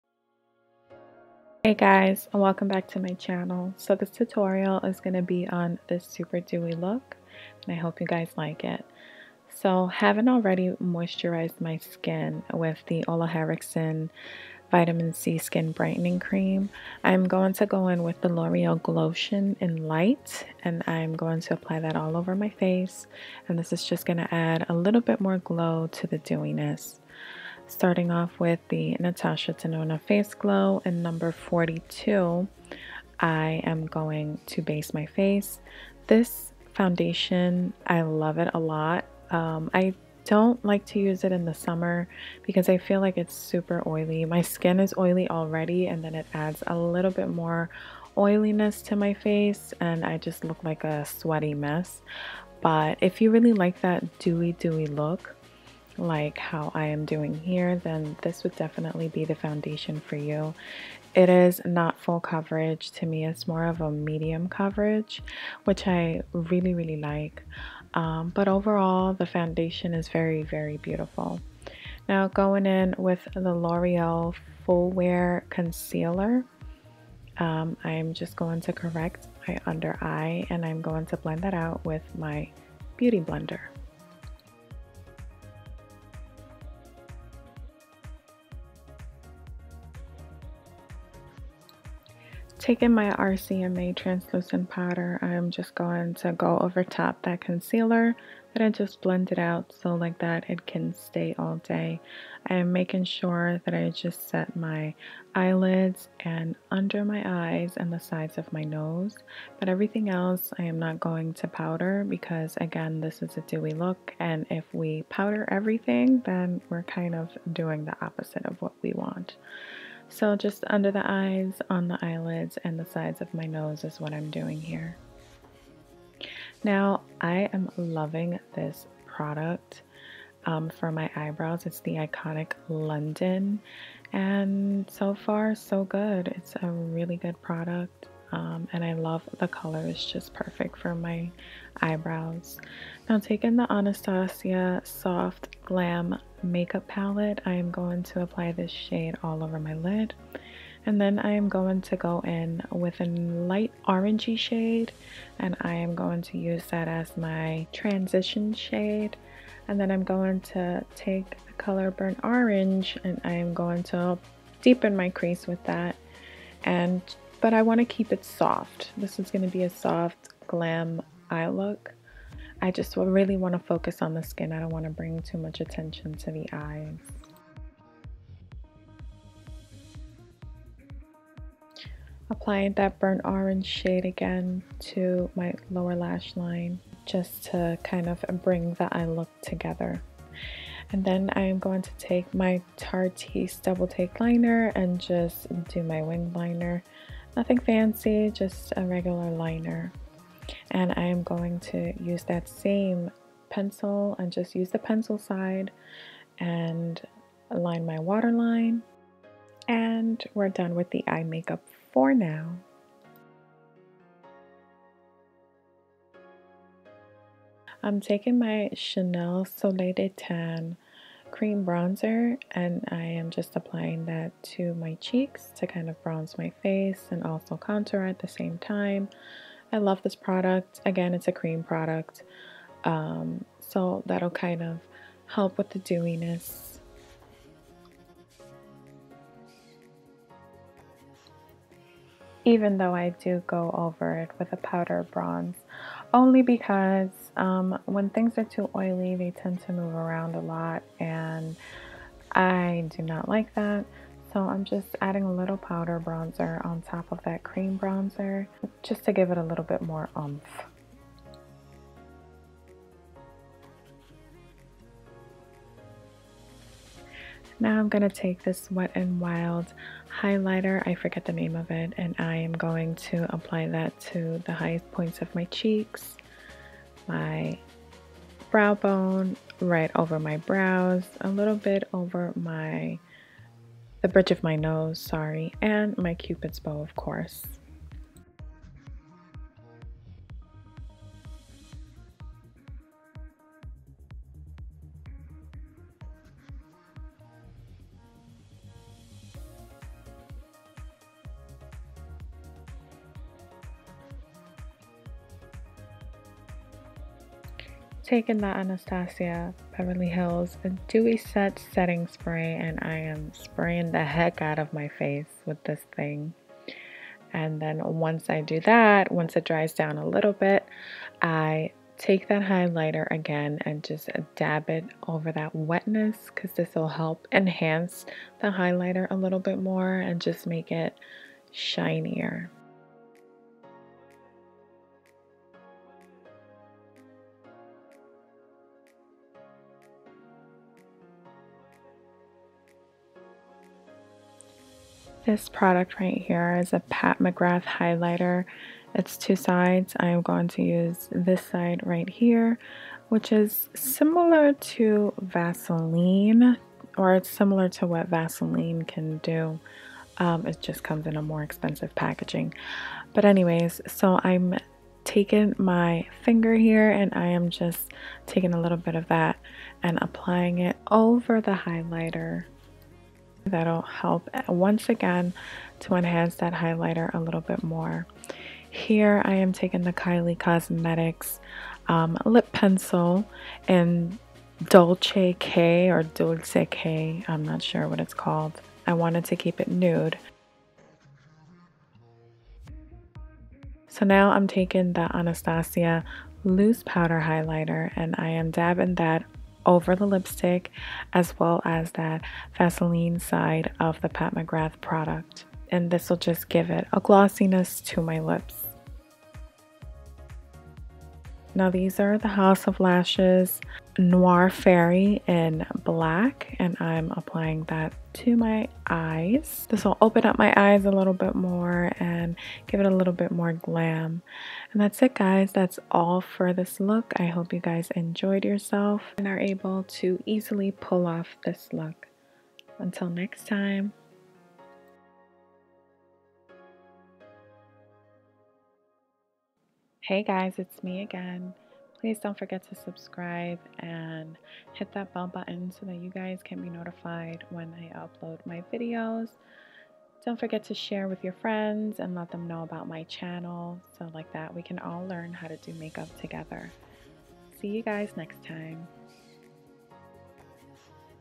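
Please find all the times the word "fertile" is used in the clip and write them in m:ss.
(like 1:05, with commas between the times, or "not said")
not said.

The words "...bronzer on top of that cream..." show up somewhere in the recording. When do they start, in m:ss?
4:16.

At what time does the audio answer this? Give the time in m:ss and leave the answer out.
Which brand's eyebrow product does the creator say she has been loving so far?
2:11.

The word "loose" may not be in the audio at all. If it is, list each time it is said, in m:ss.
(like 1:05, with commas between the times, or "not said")
6:36.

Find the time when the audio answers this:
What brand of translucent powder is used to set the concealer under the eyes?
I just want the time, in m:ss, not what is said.
1:33.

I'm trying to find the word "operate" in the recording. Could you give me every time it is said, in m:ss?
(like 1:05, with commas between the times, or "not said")
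not said.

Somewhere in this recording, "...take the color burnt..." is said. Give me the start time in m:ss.
2:40.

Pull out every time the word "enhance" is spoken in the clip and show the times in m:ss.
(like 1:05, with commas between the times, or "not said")
5:27, 6:15.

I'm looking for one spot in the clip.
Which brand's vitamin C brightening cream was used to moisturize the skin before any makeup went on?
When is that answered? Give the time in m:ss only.
0:13.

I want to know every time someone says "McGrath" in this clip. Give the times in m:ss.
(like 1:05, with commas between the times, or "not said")
5:47, 6:44.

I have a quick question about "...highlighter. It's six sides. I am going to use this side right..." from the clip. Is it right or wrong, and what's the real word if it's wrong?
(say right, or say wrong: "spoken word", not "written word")
wrong: "two", not "six".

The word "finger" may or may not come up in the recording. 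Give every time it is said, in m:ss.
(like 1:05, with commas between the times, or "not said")
6:06.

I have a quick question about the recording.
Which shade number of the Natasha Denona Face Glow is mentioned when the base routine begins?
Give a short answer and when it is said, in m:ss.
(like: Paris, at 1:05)
42, at 0:31.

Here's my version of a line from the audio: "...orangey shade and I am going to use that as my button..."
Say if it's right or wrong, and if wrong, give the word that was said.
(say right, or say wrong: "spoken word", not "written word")
wrong: "transition", not "button".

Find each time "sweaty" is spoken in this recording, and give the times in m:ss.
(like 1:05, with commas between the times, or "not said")
0:51.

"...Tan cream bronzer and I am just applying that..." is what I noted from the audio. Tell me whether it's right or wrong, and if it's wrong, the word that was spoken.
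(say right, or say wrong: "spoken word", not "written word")
right.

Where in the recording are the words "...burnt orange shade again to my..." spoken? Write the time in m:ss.
3:02.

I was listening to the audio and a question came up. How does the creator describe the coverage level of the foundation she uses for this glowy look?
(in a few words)
medium coverage.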